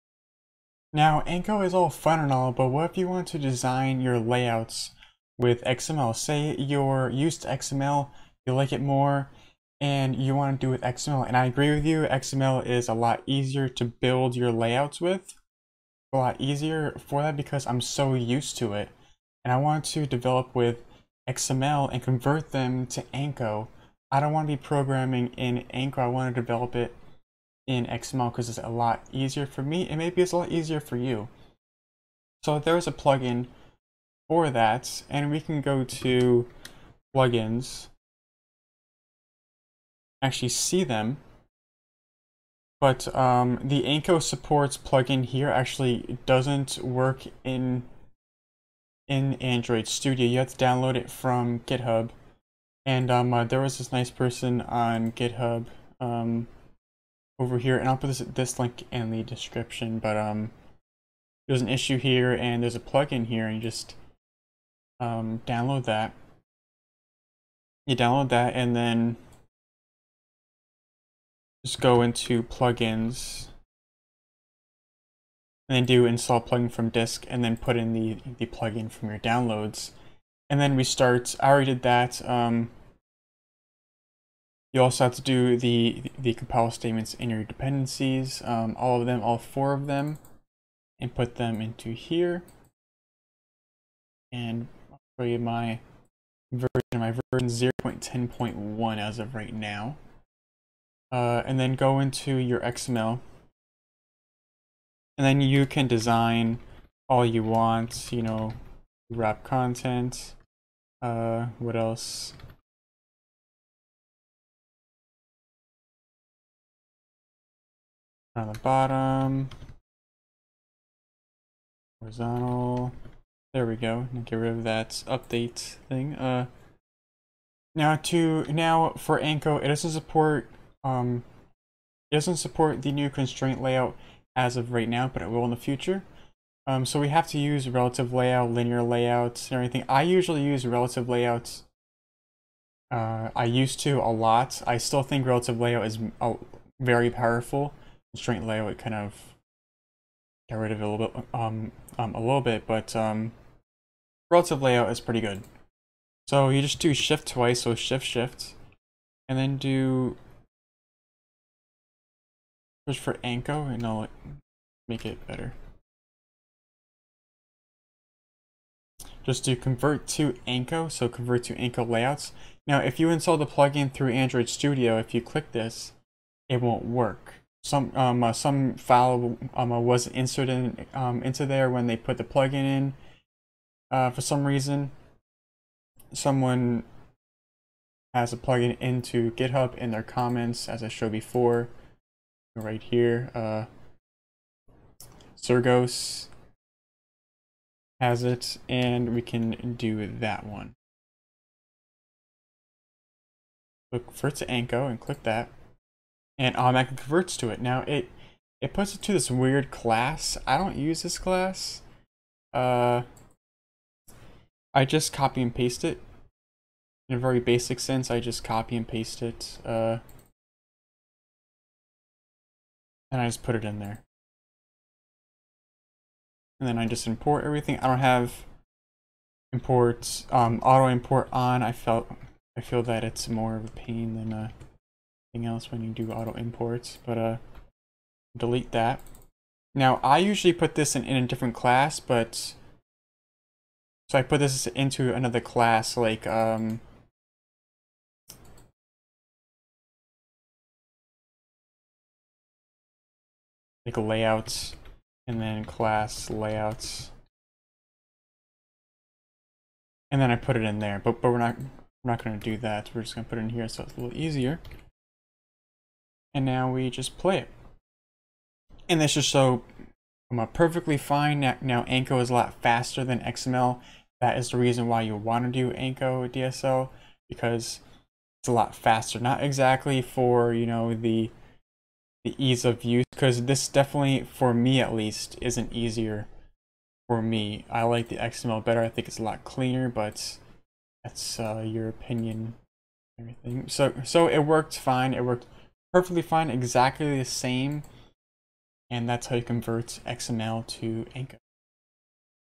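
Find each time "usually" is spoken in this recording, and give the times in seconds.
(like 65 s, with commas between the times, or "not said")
140 s, 240 s.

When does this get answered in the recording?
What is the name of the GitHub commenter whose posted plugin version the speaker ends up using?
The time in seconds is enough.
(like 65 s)
195 s.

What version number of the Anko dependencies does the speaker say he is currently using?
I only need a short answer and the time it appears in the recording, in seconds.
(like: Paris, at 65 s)
0.10.1, at 97 s.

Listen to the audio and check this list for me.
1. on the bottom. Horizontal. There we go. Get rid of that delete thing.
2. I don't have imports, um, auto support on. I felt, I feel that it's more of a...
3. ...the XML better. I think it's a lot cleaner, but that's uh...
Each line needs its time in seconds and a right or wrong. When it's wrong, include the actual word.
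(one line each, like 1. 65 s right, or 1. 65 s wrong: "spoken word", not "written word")
1. 118 s wrong: "update", not "delete"
2. 227 s wrong: "import", not "support"
3. 288 s right.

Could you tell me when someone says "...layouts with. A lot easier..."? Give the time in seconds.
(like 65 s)
14 s.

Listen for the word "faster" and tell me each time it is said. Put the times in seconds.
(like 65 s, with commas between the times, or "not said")
272 s, 278 s.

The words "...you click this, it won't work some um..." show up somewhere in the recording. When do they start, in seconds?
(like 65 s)
175 s.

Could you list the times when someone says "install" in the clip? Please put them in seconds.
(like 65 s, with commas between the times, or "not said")
76 s, 173 s.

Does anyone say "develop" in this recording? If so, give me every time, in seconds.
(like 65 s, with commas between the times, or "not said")
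20 s, 26 s.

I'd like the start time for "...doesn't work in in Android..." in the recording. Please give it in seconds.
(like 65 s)
46 s.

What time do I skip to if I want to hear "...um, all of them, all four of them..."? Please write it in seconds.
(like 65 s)
88 s.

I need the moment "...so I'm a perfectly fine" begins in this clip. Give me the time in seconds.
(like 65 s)
269 s.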